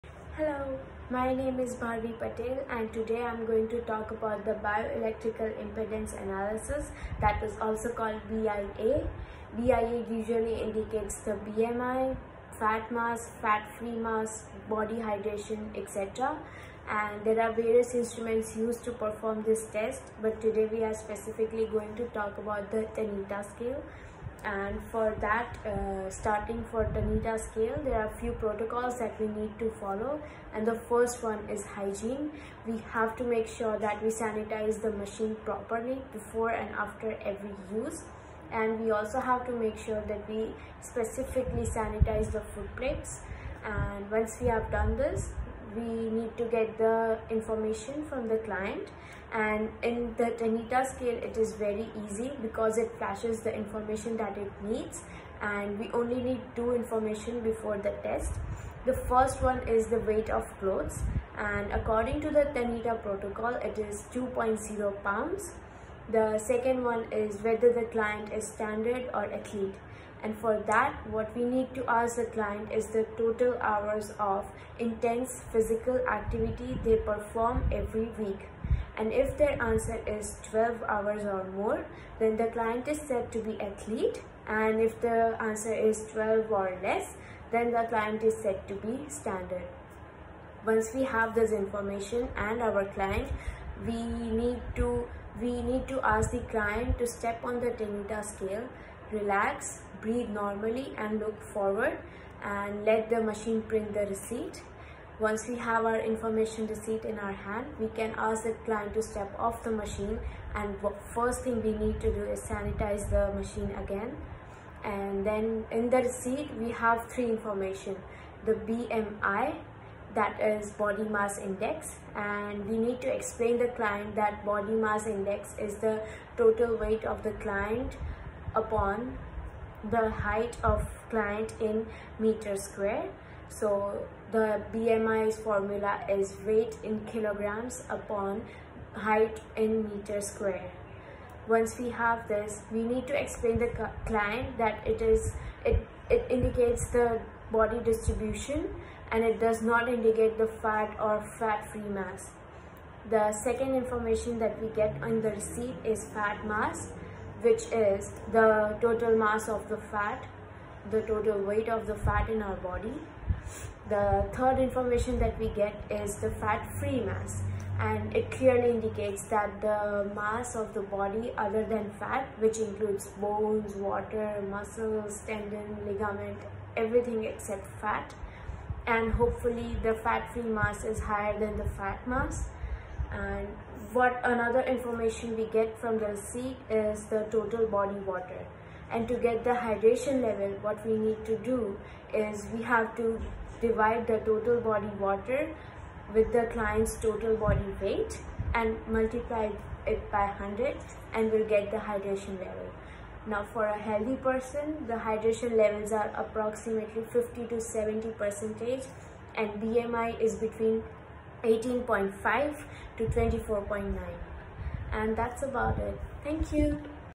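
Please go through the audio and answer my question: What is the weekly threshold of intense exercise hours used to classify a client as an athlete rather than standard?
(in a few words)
12 hours.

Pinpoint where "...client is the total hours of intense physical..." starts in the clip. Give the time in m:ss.
1:12.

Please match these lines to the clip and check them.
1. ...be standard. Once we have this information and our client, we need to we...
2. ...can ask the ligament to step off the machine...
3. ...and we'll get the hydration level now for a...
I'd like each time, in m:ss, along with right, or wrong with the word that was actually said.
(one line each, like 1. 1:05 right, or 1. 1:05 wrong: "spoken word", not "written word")
1. 1:28 right
2. 1:47 wrong: "client", not "ligament"
3. 3:21 right.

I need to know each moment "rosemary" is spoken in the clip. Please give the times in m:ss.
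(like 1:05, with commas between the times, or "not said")
not said.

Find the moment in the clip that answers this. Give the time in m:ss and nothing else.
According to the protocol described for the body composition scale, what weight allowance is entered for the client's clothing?
1:04.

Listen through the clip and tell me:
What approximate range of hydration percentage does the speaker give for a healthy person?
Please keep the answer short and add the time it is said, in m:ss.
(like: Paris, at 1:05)
50 to 70 percent, at 3:27.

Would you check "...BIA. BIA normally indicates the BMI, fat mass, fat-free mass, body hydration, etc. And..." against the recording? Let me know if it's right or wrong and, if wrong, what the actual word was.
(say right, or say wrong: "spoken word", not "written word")
wrong: "usually", not "normally".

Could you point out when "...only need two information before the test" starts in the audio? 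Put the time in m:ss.
0:55.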